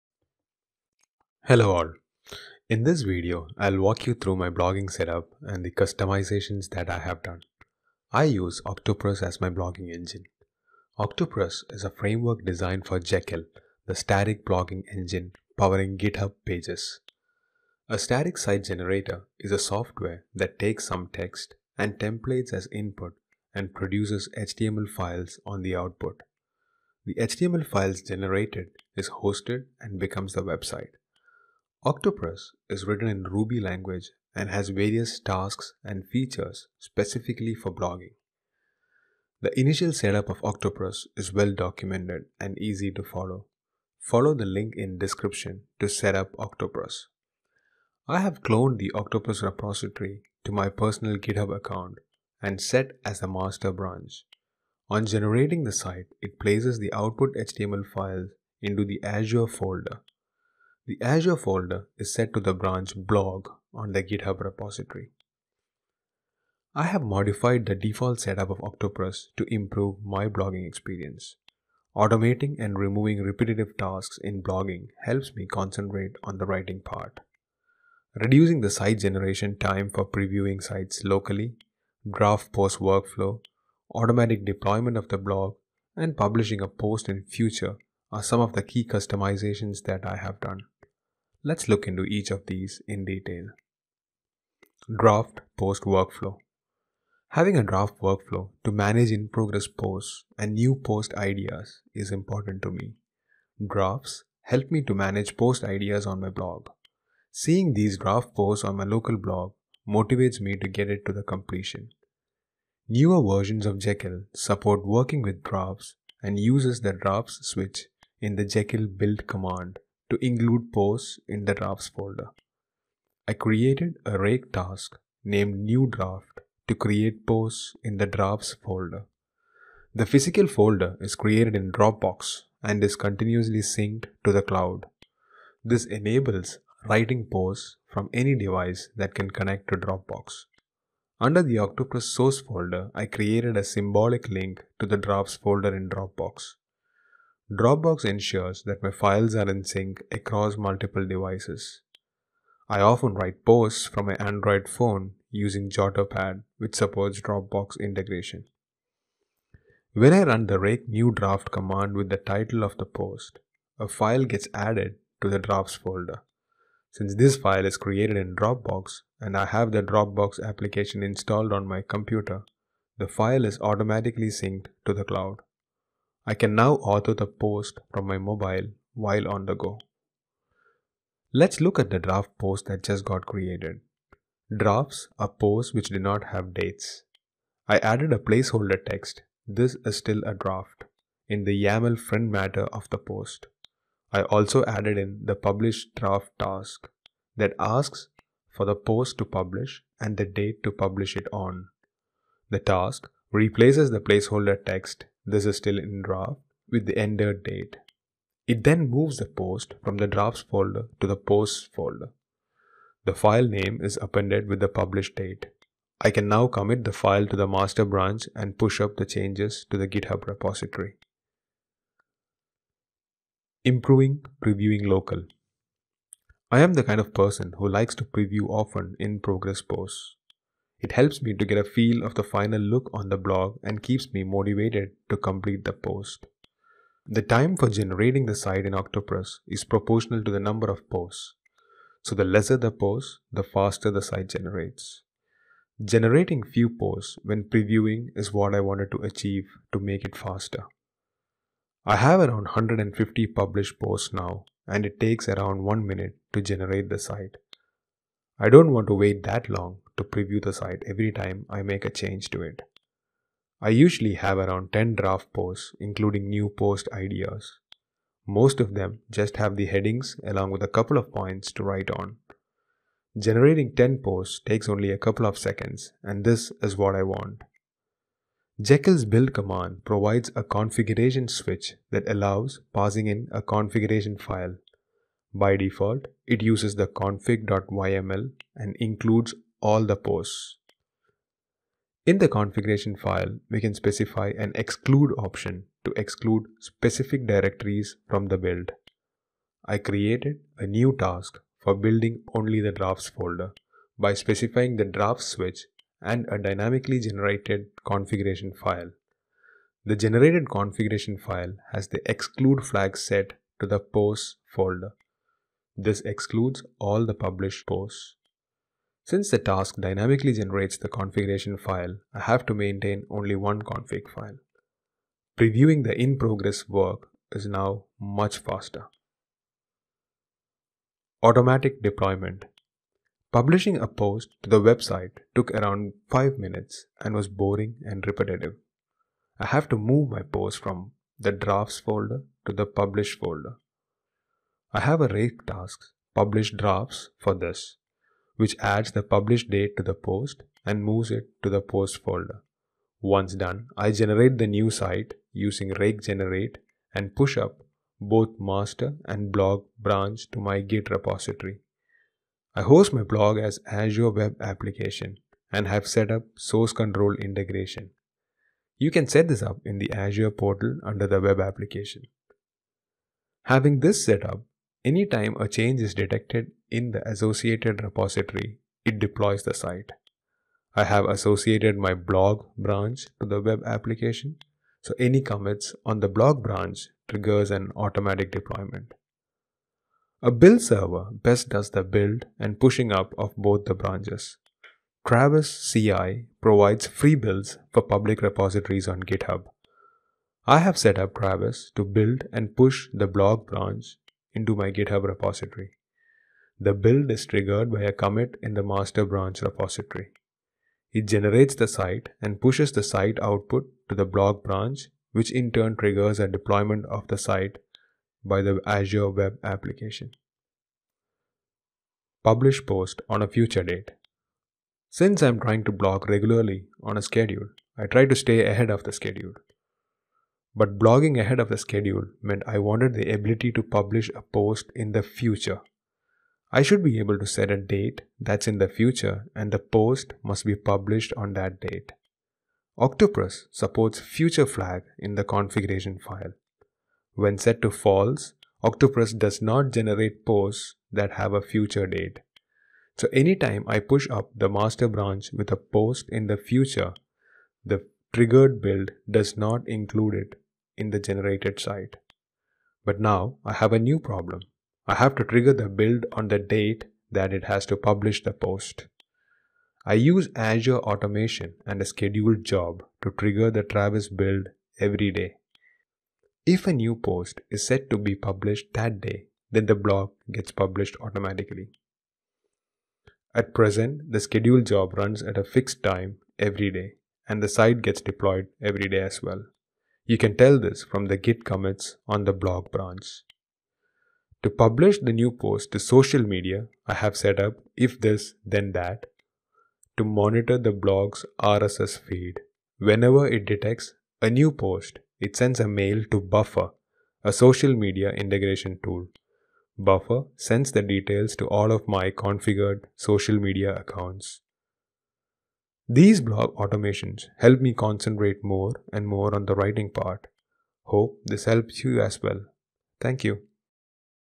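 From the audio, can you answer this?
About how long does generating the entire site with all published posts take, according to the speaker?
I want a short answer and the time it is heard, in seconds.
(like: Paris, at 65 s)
1 minute, at 255 s.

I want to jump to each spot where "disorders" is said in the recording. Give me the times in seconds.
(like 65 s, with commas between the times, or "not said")
not said.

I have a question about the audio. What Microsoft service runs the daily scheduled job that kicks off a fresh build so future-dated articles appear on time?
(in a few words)
Azure Automation.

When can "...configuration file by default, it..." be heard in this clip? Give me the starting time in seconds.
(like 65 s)
283 s.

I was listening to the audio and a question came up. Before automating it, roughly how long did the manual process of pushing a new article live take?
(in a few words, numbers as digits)
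5 minutes.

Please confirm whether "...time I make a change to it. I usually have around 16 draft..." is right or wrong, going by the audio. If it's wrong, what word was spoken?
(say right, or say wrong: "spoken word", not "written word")
wrong: "10", not "16".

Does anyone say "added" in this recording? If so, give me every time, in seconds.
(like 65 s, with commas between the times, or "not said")
164 s, 187 s, 194 s.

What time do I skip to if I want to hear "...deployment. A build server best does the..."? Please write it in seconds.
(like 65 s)
388 s.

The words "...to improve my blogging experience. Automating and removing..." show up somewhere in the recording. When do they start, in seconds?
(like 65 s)
69 s.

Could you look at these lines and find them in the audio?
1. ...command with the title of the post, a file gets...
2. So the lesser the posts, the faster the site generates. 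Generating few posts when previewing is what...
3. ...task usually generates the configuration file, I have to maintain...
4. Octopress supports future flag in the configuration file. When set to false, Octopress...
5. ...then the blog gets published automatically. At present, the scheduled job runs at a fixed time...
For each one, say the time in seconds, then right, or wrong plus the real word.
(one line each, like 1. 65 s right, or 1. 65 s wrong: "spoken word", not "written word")
1. 161 s right
2. 242 s right
3. 319 s wrong: "dynamically", not "usually"
4. 442 s right
5. 479 s right.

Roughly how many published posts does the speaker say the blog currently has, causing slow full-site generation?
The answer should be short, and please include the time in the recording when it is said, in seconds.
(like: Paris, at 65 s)
150, at 252 s.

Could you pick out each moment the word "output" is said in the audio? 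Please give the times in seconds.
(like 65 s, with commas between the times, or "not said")
25 s, 56 s, 413 s.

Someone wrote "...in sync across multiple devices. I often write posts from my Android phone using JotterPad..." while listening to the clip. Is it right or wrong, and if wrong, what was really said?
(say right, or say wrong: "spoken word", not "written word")
right.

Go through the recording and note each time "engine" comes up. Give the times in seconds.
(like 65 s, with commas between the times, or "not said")
9 s, 14 s.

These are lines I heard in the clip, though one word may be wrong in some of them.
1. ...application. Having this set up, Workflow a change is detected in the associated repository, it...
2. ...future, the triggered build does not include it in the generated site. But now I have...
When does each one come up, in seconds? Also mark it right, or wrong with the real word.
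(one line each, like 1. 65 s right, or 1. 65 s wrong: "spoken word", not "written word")
1. 371 s wrong: "Anytime", not "Workflow"
2. 456 s right.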